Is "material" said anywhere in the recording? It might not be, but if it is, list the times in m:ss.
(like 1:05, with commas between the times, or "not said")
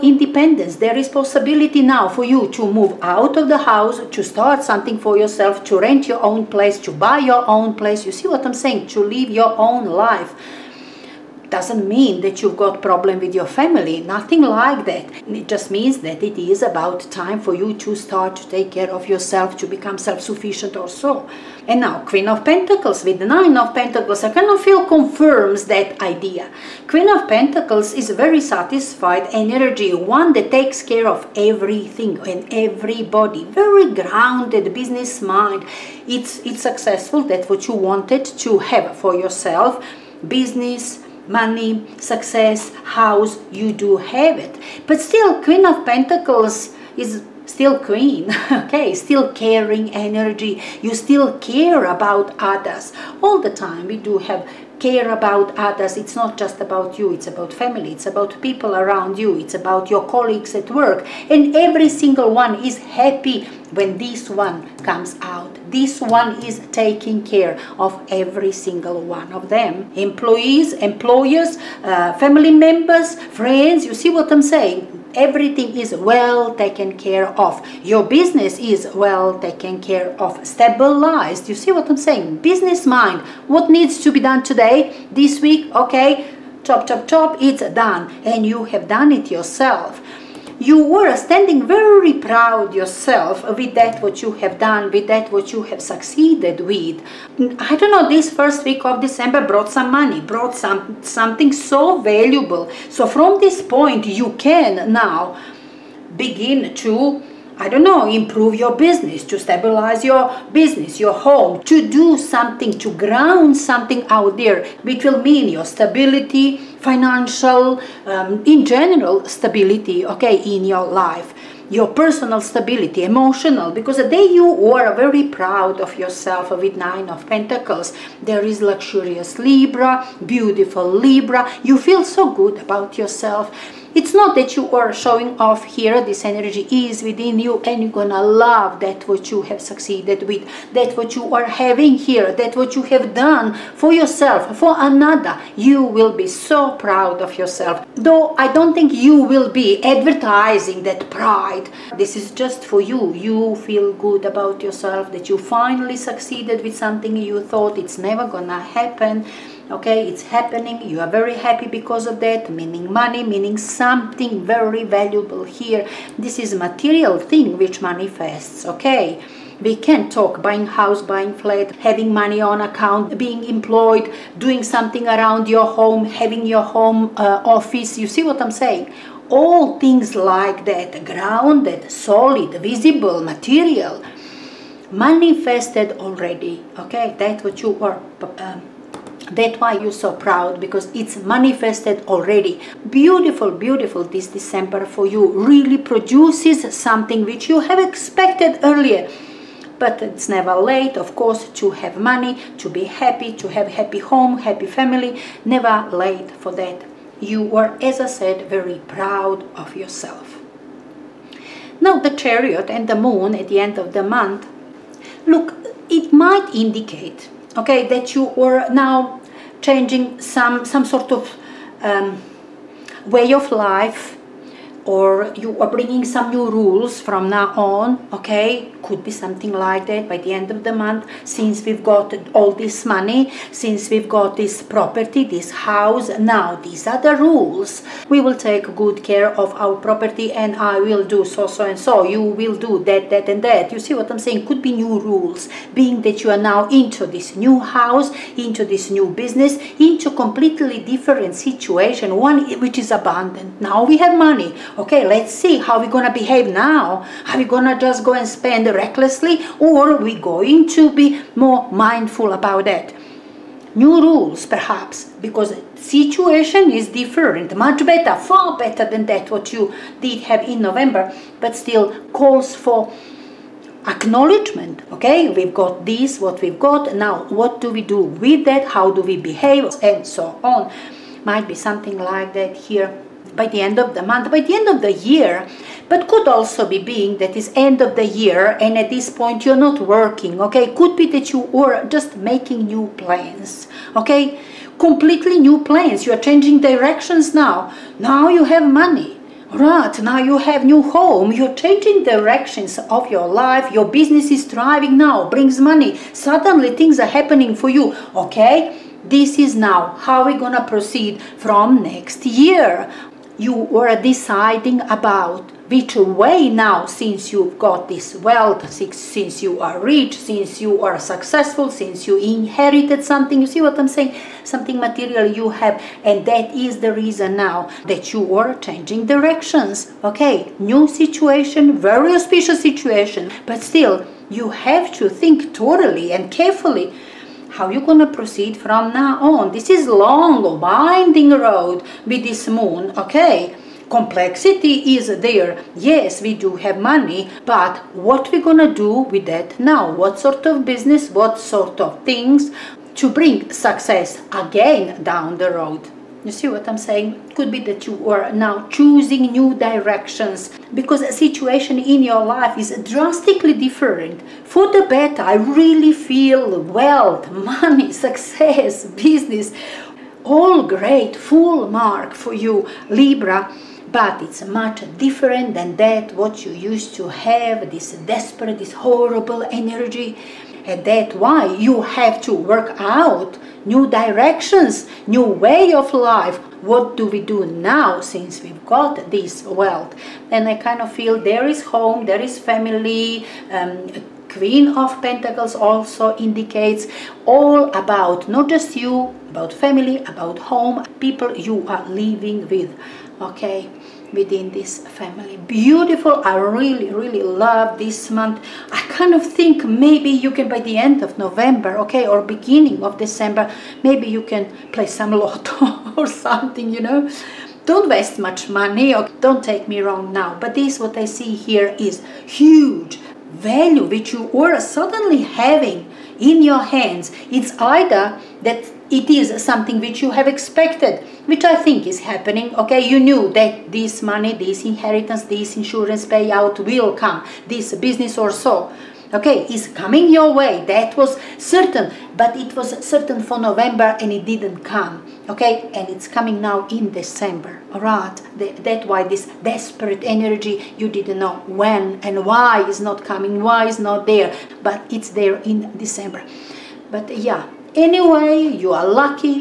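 2:46, 3:03, 5:24.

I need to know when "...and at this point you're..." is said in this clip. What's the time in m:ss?
4:48.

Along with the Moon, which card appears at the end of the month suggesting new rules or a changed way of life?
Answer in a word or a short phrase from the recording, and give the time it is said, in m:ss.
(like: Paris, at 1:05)
The Chariot, at 3:31.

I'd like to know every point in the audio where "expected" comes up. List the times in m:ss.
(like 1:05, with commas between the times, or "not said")
3:17, 7:10.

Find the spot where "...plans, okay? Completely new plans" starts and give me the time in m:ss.
4:52.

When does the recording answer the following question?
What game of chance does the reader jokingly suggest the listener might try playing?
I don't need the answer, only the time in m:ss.
6:55.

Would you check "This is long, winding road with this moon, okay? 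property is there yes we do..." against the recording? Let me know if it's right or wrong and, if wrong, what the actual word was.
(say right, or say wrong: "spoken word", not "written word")
wrong: "complexity", not "property".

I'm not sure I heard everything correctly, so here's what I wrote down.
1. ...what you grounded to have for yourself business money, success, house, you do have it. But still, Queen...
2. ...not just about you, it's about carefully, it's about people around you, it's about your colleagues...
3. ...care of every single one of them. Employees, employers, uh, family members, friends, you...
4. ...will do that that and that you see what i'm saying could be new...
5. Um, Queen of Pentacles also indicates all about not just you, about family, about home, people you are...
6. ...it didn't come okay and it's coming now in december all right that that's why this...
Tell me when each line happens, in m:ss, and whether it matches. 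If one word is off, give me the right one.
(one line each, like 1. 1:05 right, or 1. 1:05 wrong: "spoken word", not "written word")
1. 0:37 wrong: "wanted", not "grounded"
2. 0:56 wrong: "family", not "carefully"
3. 1:07 right
4. 4:02 right
5. 6:33 right
6. 7:24 right.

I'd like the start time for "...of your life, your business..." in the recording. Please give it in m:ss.
5:02.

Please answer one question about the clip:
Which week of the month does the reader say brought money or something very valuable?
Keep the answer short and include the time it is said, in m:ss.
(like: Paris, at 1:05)
first week of December, at 1:38.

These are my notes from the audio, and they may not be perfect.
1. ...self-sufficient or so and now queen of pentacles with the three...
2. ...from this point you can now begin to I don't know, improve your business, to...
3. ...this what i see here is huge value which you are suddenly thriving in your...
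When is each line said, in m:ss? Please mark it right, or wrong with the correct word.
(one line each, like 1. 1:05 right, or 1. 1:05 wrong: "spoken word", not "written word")
1. 0:19 wrong: "nine", not "three"
2. 1:43 right
3. 7:00 wrong: "having", not "thriving".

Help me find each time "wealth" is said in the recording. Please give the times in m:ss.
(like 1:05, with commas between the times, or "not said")
5:18, 6:06, 6:29.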